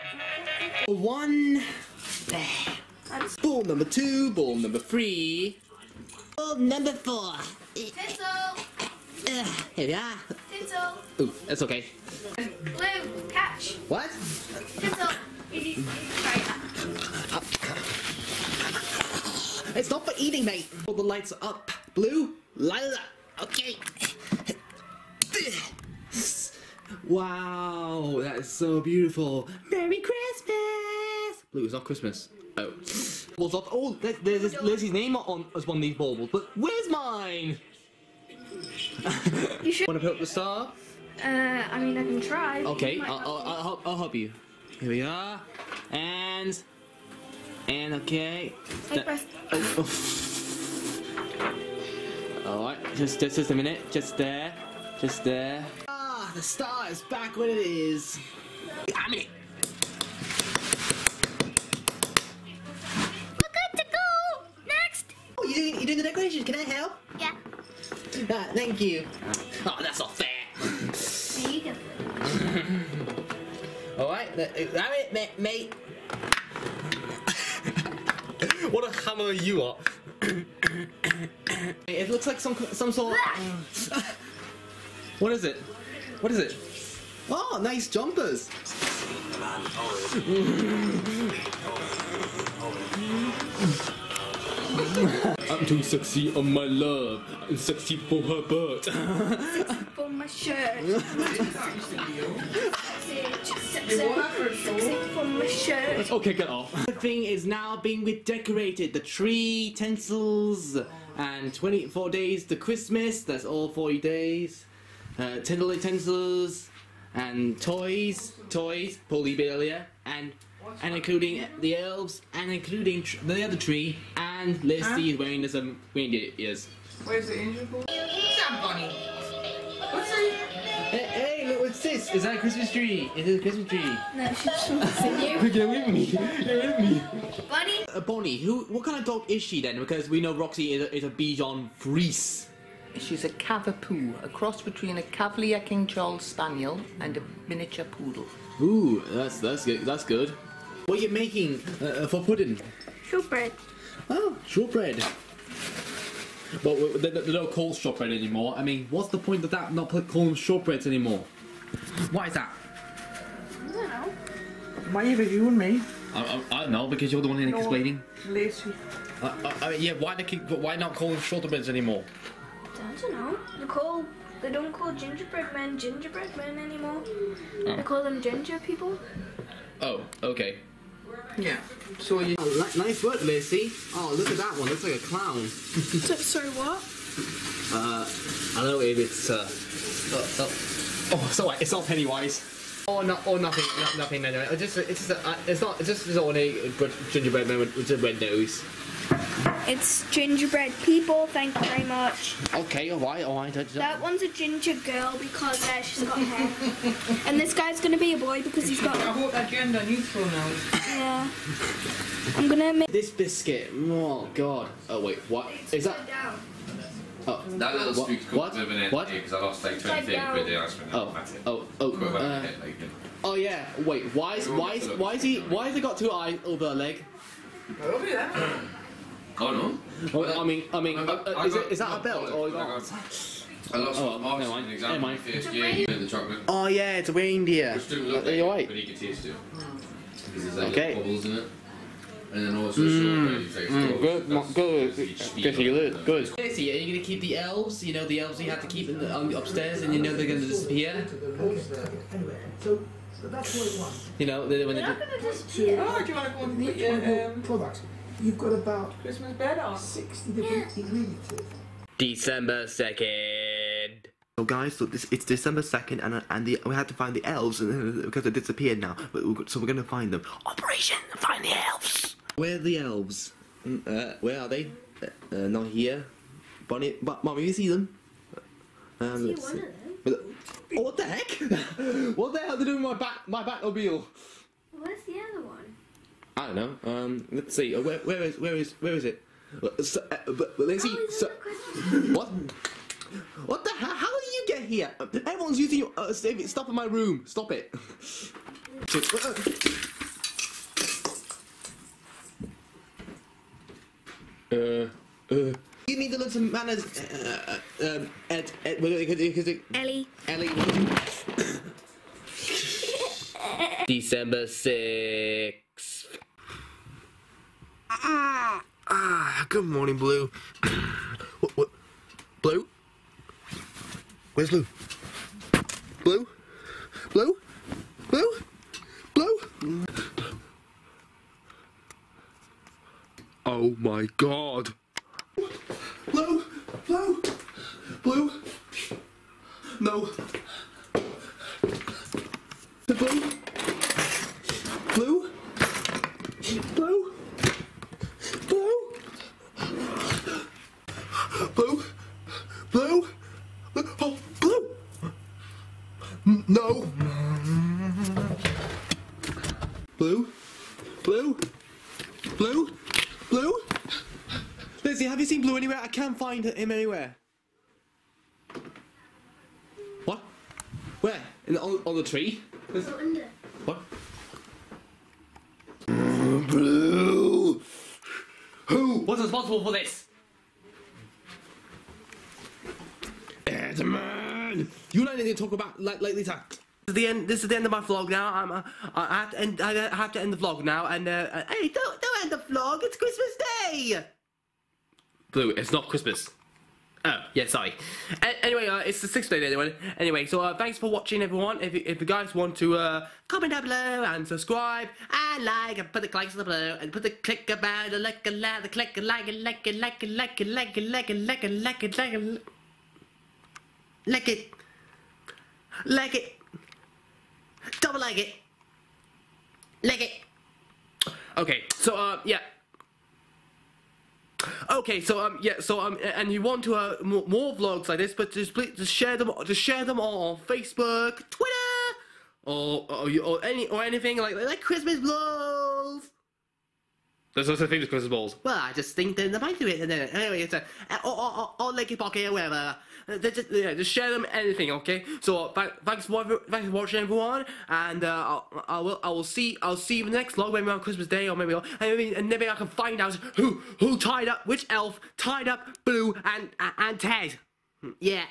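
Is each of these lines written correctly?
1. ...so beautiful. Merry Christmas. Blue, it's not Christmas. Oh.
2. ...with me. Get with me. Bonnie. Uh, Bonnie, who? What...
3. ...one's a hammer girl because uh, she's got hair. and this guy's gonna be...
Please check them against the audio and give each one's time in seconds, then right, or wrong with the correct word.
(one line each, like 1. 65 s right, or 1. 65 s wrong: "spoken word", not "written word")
1. 28 s right
2. 135 s right
3. 204 s wrong: "ginger", not "hammer".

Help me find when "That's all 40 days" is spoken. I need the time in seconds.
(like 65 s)
113 s.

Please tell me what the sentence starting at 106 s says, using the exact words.
The thing is now being redecorated.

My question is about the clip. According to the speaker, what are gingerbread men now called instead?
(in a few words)
Ginger people.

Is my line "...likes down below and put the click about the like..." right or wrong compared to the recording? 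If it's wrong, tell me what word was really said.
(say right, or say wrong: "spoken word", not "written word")
right.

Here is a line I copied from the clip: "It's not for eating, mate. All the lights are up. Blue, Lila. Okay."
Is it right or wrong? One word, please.
right.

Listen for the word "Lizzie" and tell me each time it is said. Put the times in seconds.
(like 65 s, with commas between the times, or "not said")
124 s, 364 s.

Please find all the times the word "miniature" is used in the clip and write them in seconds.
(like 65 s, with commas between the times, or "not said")
147 s.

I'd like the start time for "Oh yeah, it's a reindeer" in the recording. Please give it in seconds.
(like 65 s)
236 s.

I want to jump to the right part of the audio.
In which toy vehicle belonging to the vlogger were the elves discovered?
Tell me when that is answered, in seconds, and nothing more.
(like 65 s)
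283 s.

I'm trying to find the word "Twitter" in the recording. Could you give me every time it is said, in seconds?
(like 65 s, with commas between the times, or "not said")
431 s.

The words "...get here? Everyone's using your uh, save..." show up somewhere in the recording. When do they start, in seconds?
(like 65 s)
294 s.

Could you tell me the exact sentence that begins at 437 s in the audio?
There's are such thing as Christmas balls.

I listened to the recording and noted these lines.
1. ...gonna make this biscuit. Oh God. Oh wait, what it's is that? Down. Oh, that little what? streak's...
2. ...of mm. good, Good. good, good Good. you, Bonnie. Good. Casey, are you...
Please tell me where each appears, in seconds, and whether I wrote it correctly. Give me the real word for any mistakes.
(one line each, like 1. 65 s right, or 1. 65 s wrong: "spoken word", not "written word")
1. 212 s right
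2. 243 s wrong: "Luke", not "Bonnie".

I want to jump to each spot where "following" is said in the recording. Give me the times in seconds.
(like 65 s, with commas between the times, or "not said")
not said.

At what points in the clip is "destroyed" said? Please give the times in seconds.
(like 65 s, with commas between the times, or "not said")
not said.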